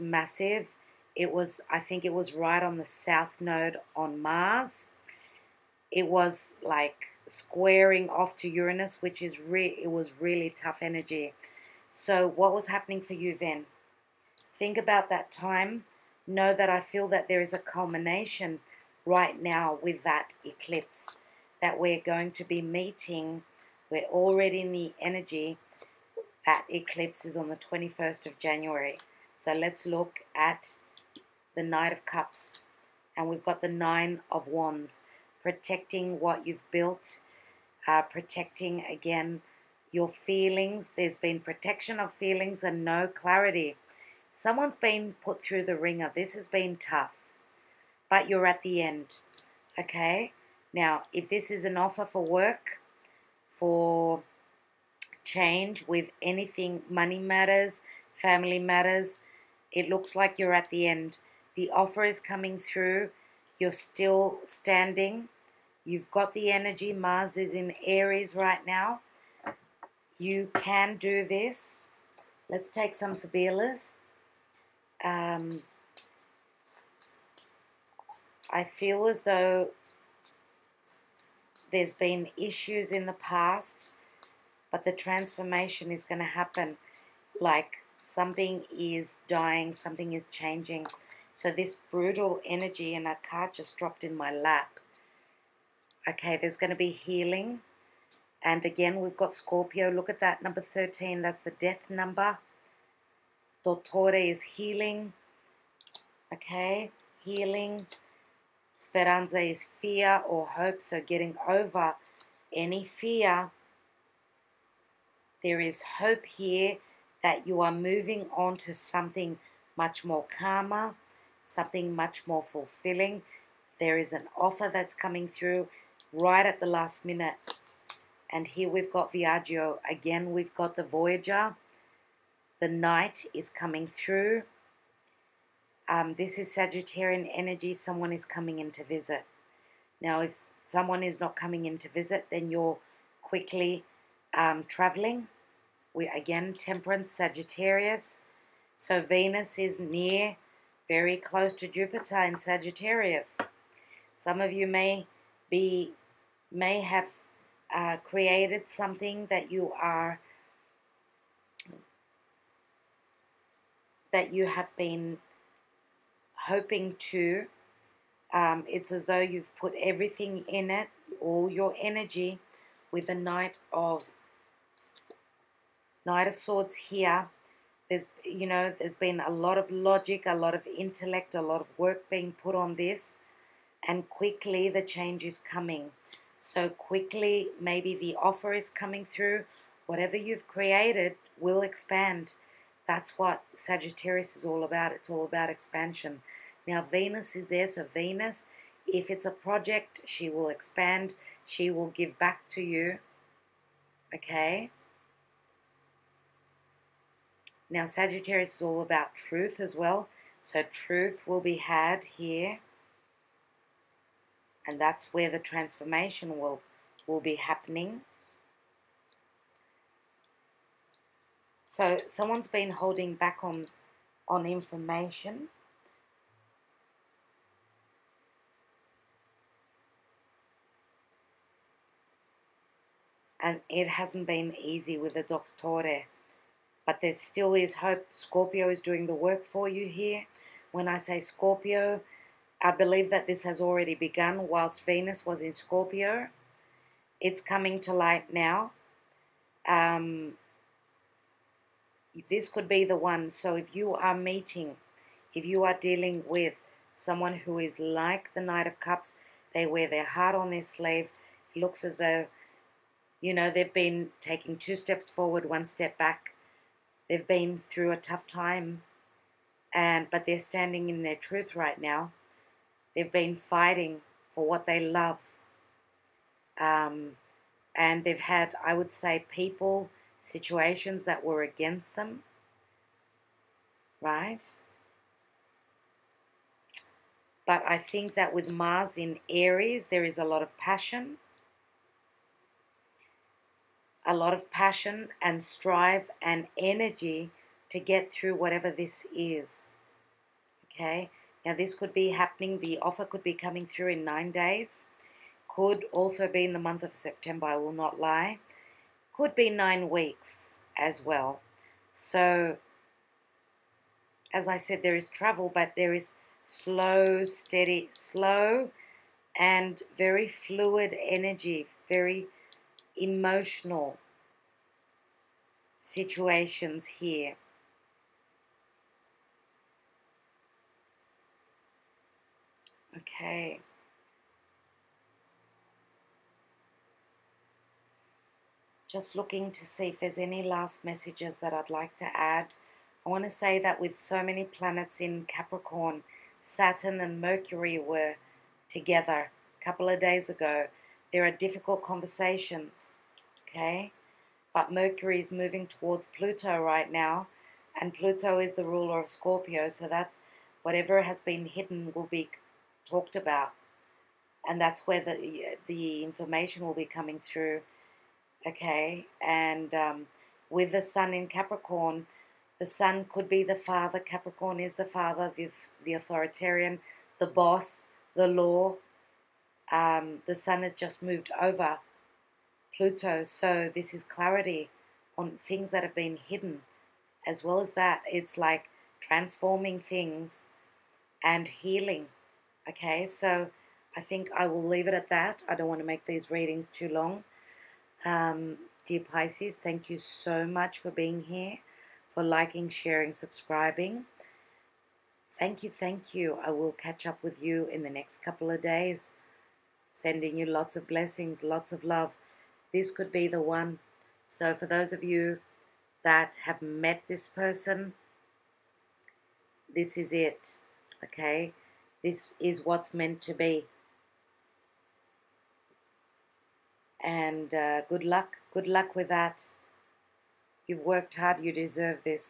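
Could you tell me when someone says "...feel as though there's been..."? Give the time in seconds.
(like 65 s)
78 s.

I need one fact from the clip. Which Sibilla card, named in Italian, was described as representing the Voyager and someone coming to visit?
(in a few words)
Viaggio.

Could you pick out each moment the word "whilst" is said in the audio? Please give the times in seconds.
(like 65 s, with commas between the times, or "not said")
244 s.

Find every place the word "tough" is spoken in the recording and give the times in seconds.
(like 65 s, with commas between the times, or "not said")
10 s, 46 s, 267 s.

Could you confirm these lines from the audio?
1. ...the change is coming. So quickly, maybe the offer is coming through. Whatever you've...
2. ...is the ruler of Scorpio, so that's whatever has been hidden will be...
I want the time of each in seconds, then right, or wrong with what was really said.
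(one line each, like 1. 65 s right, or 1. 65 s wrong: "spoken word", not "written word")
1. 184 s right
2. 358 s right.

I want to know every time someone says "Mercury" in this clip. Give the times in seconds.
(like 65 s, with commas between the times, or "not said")
347 s, 354 s.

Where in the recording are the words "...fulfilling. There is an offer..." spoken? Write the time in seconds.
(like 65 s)
122 s.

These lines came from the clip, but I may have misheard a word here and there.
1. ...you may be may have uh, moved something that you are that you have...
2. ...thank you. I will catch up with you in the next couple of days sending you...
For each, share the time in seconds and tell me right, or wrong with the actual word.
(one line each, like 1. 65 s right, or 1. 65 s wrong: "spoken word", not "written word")
1. 154 s wrong: "created", not "moved"
2. 405 s right.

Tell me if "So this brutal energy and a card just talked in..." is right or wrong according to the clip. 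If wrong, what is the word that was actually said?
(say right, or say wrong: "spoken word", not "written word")
wrong: "dropped", not "talked".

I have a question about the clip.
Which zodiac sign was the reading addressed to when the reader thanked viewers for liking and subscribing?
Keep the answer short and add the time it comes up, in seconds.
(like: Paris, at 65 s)
Pisces, at 399 s.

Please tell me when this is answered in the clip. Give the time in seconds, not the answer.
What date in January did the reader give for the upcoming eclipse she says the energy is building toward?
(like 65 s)
27 s.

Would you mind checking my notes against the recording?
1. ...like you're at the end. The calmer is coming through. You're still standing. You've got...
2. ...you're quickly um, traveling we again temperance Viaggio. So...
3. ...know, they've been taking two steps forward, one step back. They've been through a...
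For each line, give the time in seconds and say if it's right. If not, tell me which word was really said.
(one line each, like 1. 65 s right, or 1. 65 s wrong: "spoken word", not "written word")
1. 60 s wrong: "offer", not "calmer"
2. 142 s wrong: "Sagittarius", not "Viaggio"
3. 263 s right.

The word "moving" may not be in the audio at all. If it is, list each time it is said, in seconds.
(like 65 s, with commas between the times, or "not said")
117 s, 355 s.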